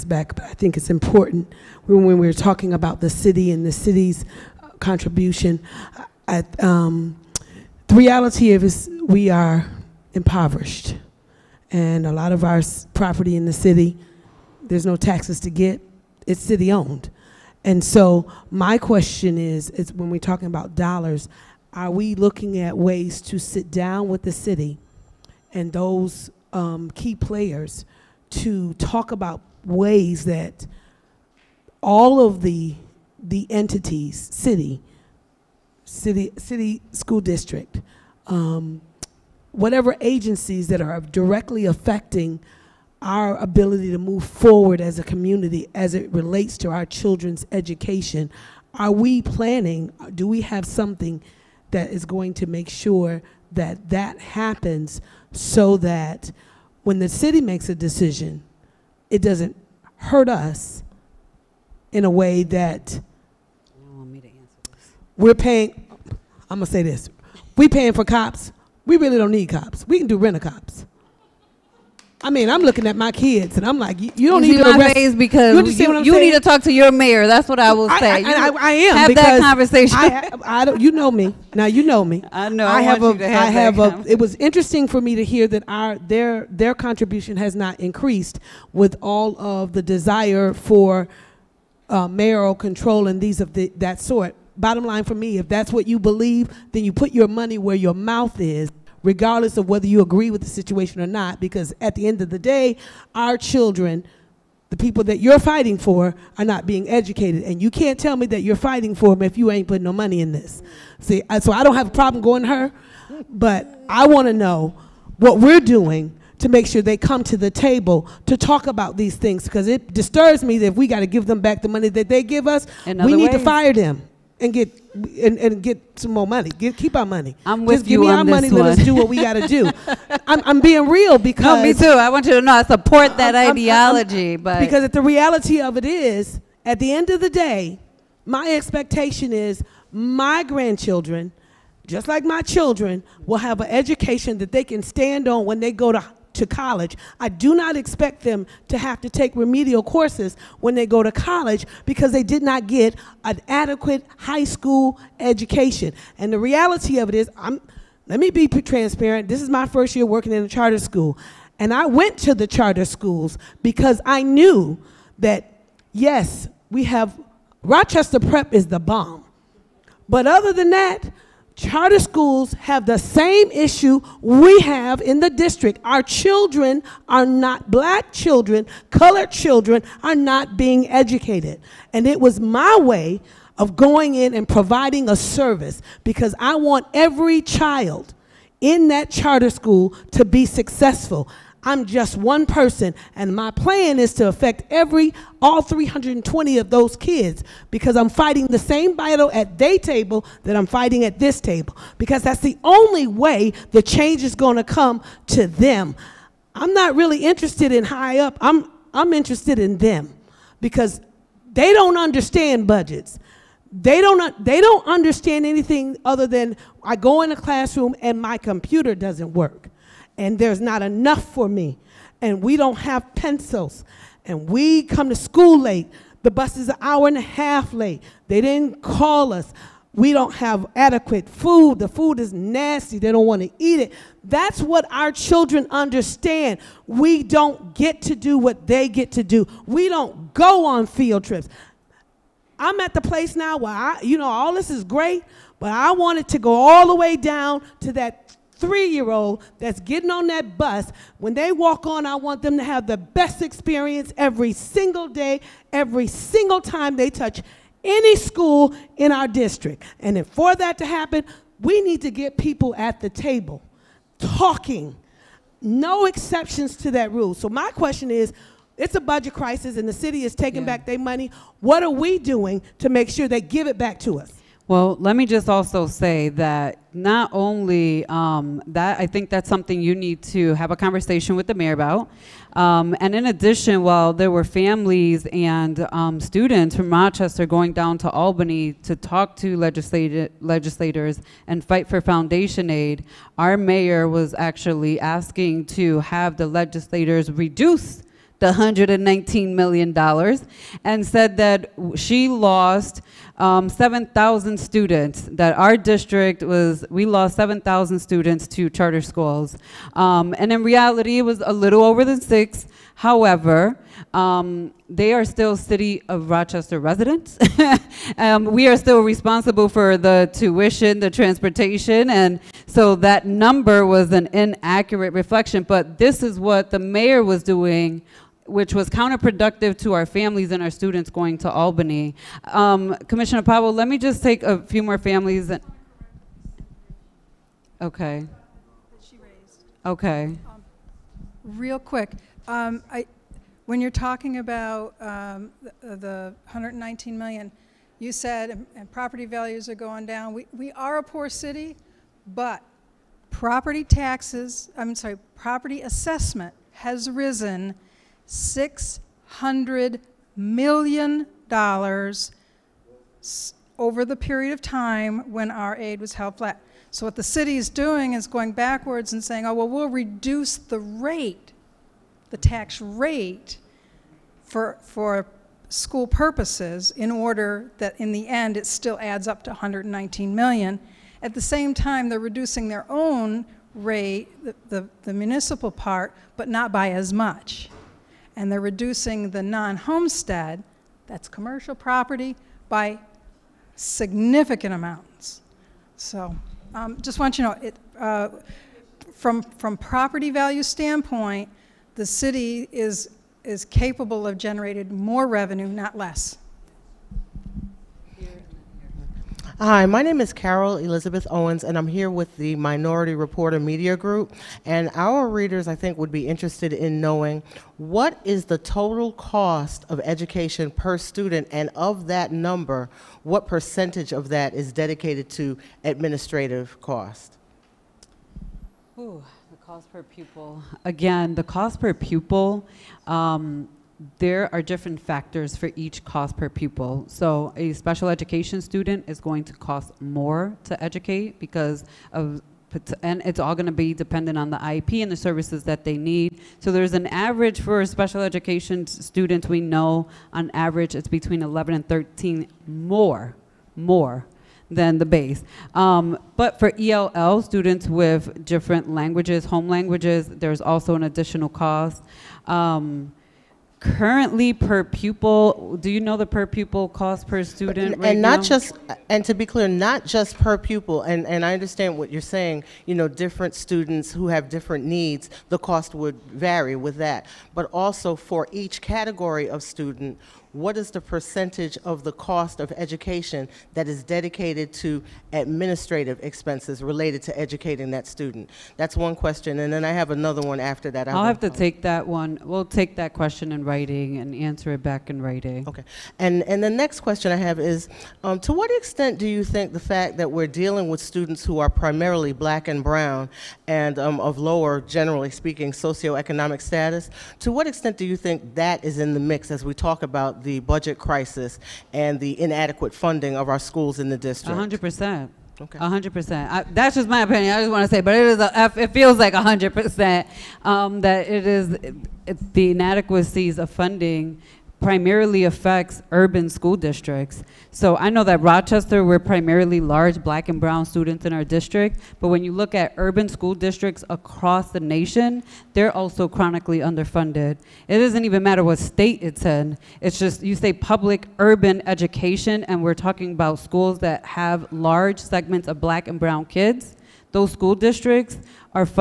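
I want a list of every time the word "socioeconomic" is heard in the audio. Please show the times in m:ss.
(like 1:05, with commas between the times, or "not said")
8:25.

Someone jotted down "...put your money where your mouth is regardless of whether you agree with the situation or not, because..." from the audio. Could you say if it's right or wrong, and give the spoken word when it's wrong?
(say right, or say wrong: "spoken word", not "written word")
right.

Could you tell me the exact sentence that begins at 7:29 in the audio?
We know on average it's between 11 and 13 more, more than the base.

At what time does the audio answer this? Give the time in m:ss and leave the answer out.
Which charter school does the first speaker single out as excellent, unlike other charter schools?
2:47.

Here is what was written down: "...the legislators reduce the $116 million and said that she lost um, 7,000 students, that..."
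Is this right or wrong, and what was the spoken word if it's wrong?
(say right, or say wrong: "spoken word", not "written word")
wrong: "119", not "116".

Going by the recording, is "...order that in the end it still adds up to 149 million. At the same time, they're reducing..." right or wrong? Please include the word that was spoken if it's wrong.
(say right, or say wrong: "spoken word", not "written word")
wrong: "119", not "149".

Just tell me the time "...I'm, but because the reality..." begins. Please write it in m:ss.
2:14.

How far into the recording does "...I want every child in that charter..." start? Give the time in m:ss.
3:06.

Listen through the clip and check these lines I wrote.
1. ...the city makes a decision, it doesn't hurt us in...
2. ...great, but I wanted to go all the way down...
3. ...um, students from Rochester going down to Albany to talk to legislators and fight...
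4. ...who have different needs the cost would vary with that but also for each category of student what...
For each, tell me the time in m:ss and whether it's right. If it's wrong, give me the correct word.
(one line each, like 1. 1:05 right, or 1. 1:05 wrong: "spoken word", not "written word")
1. 0:56 right
2. 4:04 right
3. 4:45 right
4. 7:54 right.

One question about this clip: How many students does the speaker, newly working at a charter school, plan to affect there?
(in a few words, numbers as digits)
320.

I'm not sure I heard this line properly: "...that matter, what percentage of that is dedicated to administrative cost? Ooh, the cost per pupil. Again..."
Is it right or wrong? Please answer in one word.
wrong.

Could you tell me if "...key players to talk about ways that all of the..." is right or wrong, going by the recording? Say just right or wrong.
right.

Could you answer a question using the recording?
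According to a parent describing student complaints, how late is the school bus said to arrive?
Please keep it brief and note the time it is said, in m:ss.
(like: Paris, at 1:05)
An hour and a half, at 3:46.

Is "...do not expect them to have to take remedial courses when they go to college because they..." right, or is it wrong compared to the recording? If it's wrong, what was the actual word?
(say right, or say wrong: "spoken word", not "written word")
right.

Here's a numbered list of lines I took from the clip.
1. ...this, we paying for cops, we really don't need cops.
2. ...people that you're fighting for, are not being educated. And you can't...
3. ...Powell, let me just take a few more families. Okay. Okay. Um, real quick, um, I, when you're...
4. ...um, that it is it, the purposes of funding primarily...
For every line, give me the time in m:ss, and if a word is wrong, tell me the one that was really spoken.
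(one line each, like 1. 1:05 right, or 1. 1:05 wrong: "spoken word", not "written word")
1. 1:06 right
2. 1:44 right
3. 5:33 right
4. 8:40 wrong: "inadequacies", not "purposes".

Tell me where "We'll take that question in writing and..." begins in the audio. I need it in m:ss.
8:12.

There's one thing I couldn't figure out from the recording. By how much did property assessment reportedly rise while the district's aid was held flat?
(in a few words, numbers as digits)
$600 million.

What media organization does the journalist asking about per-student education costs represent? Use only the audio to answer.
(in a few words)
Minority Reporter Media Group.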